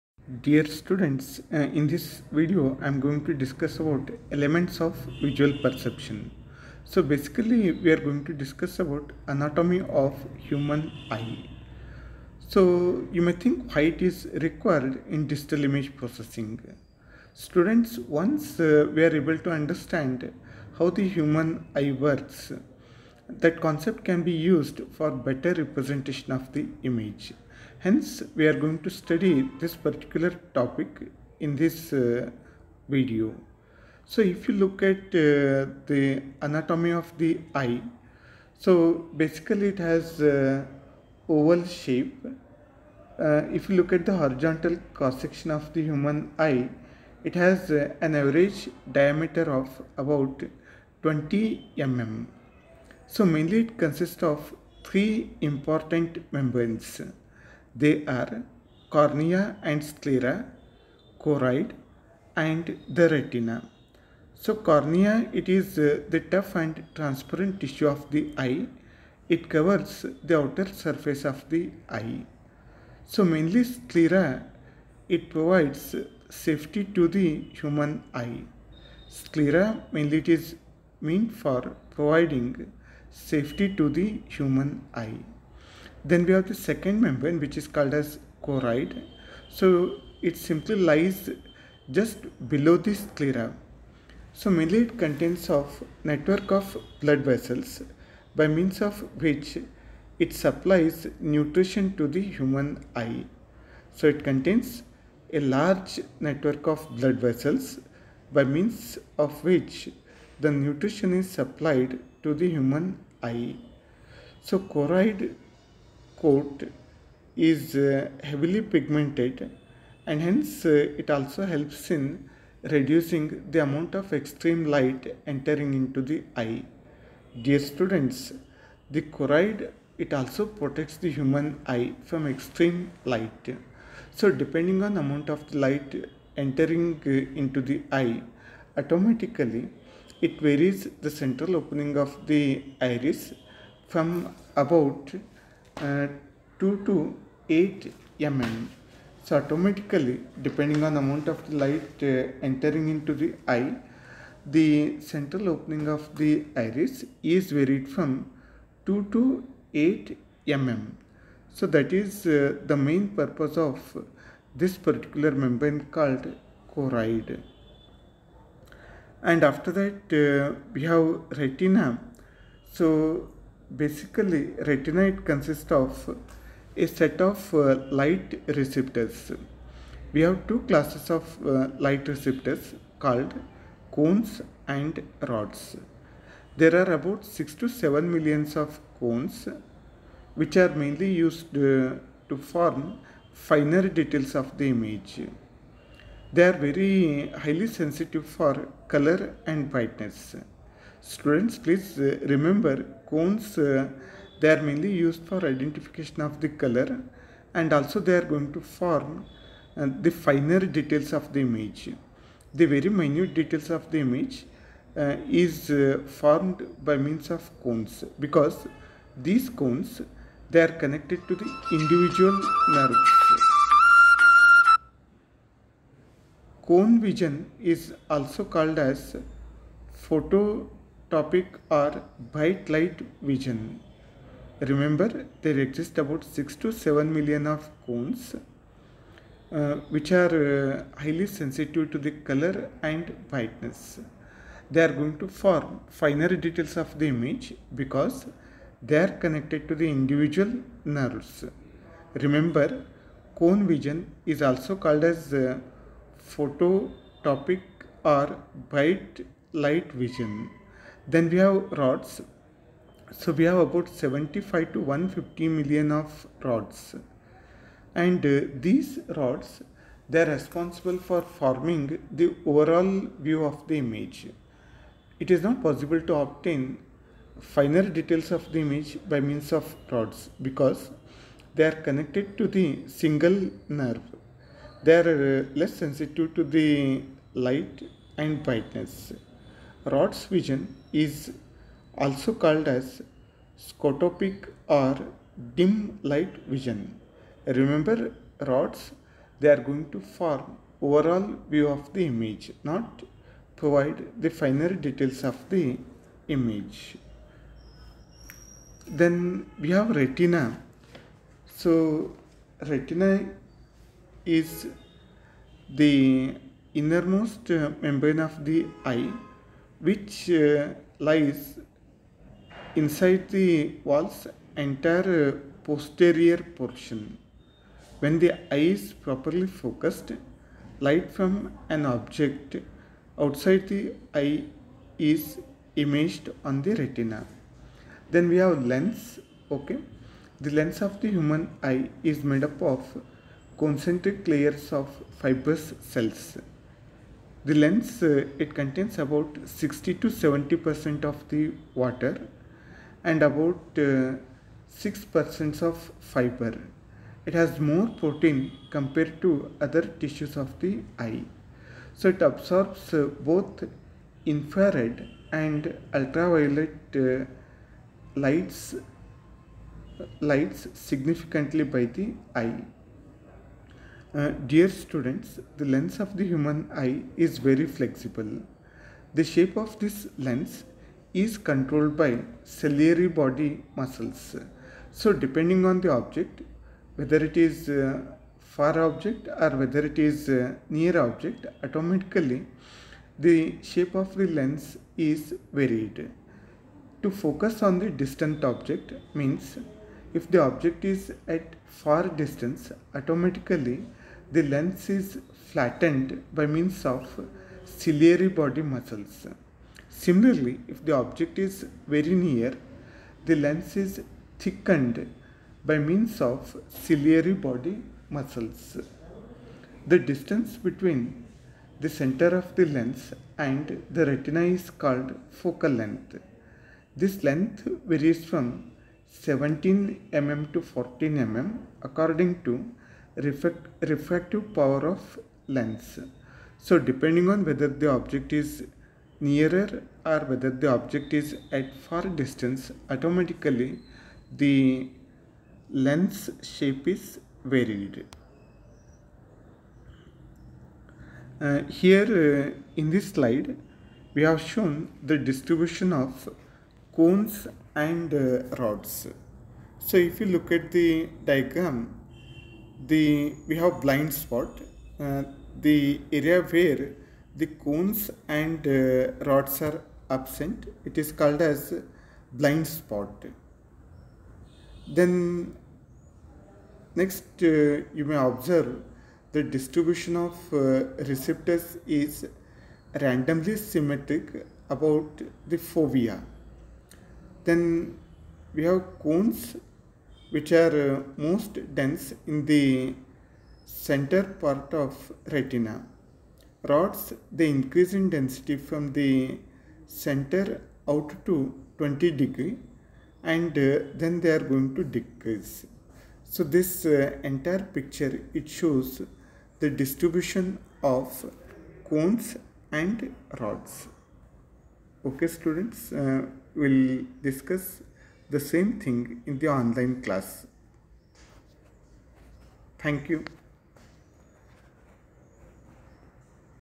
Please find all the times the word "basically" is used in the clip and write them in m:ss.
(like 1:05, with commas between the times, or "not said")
0:07, 0:39, 2:53.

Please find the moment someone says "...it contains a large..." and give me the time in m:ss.
1:44.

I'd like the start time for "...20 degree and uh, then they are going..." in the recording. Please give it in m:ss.
8:21.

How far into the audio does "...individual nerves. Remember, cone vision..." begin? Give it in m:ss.
4:09.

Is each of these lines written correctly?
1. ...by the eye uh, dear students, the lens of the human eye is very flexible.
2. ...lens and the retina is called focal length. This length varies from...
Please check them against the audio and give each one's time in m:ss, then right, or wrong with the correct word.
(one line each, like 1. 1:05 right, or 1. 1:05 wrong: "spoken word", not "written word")
1. 6:11 right
2. 7:02 right.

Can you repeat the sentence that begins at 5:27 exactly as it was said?
When the eye is properly focused, light from an object outside the eye is imaged on the retina.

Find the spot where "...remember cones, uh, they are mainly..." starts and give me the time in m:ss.
3:22.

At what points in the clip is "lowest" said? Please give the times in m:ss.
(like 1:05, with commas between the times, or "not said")
not said.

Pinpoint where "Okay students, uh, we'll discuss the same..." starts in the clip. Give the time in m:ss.
8:35.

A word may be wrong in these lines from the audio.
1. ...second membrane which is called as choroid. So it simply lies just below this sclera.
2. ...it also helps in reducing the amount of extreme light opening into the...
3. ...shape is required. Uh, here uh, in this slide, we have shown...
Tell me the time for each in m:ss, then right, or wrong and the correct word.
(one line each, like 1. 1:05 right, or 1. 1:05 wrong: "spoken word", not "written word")
1. 1:26 right
2. 2:01 wrong: "entering", not "opening"
3. 7:26 wrong: "varied", not "required".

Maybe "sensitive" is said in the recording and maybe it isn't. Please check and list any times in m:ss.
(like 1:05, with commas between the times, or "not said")
3:17, 4:01, 4:45.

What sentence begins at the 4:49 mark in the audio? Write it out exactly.
Rod's vision is also called as scotopic or dim light vision.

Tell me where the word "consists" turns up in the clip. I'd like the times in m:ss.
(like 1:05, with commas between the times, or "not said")
0:53, 2:55.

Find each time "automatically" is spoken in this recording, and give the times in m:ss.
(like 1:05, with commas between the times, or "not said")
2:18, 2:29, 6:31, 6:42, 7:22.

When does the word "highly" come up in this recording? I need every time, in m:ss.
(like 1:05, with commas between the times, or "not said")
3:17, 4:01.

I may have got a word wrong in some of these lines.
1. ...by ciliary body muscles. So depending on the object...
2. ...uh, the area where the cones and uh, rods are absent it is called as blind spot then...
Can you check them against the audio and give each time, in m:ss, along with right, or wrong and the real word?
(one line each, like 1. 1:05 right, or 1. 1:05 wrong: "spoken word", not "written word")
1. 6:21 right
2. 7:44 right.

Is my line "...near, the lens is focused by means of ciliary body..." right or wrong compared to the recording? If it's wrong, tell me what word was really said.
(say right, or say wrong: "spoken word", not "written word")
wrong: "thickened", not "focused".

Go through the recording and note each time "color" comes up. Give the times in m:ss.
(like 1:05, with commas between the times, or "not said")
3:18, 3:26, 4:02.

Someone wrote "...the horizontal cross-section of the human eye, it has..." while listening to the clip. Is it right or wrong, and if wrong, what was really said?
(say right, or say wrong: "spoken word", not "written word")
right.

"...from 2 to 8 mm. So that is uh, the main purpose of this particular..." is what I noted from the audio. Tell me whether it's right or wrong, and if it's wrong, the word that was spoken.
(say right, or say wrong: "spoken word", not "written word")
right.